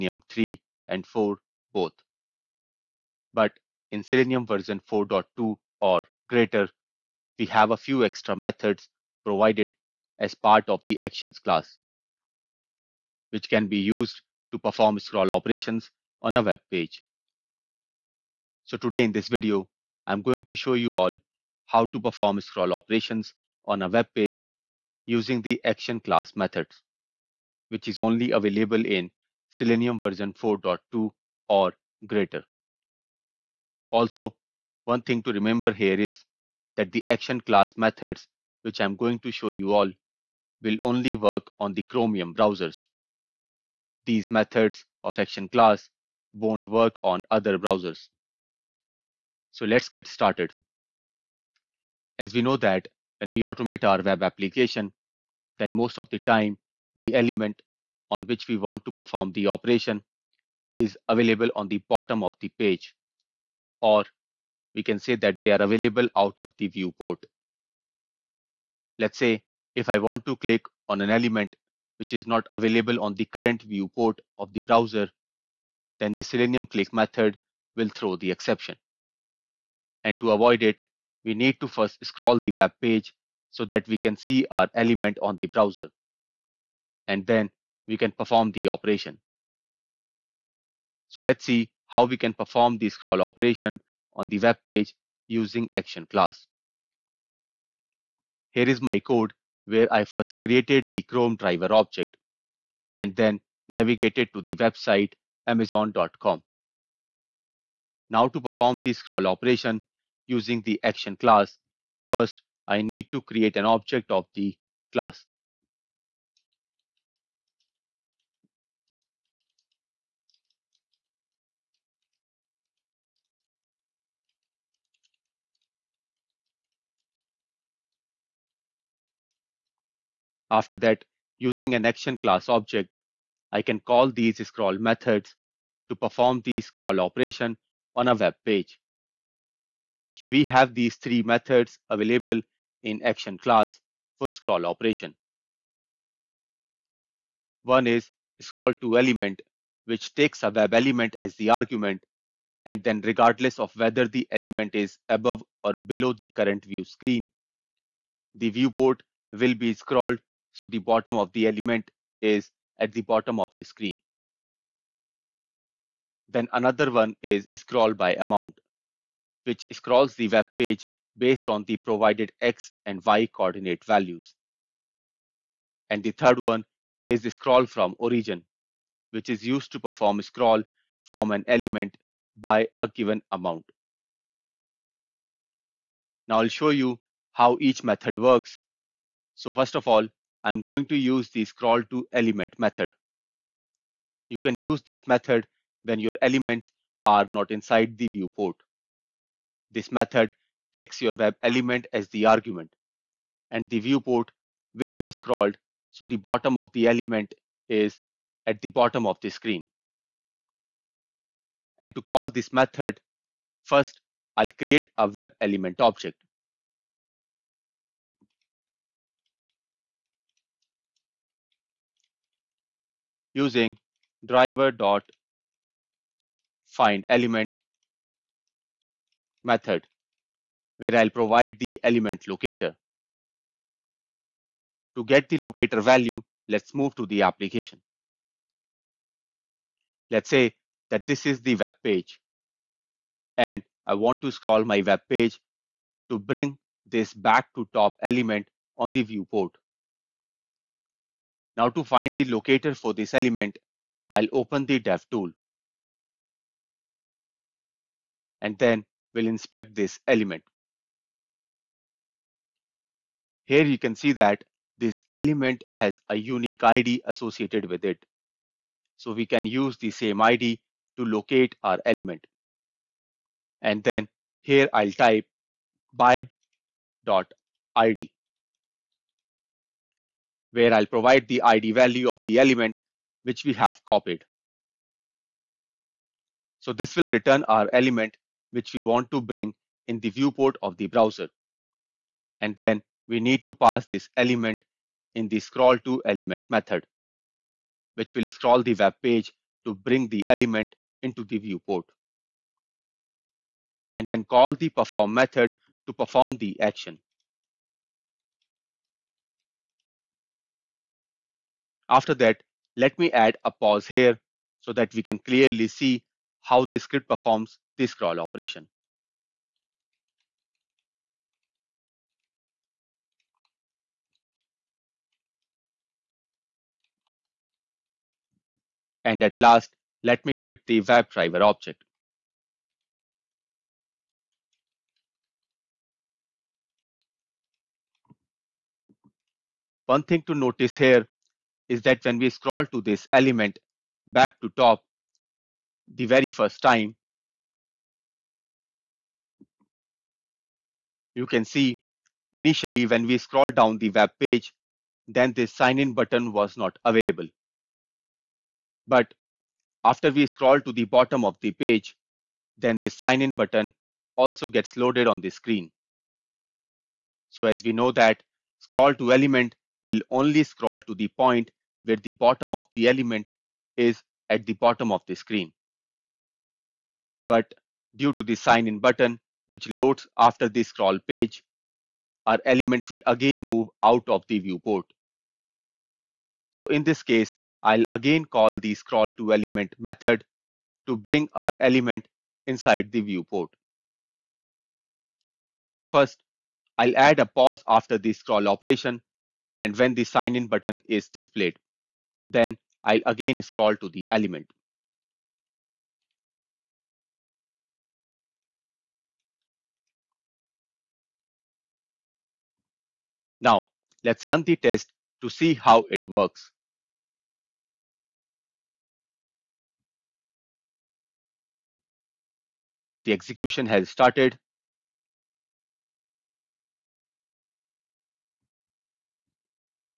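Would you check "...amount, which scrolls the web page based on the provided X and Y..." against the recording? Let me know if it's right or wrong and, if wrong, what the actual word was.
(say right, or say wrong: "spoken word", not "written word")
right.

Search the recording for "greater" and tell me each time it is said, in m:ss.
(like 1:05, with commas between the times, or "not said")
0:06, 0:32.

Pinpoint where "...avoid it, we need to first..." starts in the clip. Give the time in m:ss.
1:20.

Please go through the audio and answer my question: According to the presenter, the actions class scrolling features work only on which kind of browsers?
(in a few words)
Chromium browsers.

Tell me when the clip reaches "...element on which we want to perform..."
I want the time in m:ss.
0:57.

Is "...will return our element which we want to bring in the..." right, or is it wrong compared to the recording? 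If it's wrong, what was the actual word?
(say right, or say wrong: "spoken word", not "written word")
right.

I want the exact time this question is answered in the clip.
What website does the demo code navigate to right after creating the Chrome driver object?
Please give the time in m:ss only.
1:45.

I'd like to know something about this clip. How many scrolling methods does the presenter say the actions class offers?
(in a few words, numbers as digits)
3.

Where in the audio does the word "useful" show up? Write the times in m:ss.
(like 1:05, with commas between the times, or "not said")
not said.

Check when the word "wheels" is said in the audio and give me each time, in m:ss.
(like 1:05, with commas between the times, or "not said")
not said.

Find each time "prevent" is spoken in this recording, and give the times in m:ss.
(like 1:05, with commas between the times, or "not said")
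not said.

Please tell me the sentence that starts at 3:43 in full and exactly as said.
using driver dot find element method where I'll provide the element locator.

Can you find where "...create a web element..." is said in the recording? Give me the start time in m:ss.
3:34.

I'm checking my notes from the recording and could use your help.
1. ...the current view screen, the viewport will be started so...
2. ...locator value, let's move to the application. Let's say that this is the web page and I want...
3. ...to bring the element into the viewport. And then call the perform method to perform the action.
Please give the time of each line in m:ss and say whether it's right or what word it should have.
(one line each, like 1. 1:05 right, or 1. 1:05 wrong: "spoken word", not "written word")
1. 2:36 wrong: "scrolled", not "started"
2. 3:55 right
3. 4:59 right.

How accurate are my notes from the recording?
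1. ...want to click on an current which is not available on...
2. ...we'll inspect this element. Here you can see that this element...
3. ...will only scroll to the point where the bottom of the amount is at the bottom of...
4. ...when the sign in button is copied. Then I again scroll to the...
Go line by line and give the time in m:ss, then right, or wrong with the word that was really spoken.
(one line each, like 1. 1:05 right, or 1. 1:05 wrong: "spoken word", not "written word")
1. 1:09 wrong: "element", not "current"
2. 4:19 right
3. 6:09 wrong: "element", not "amount"
4. 6:39 wrong: "displayed", not "copied".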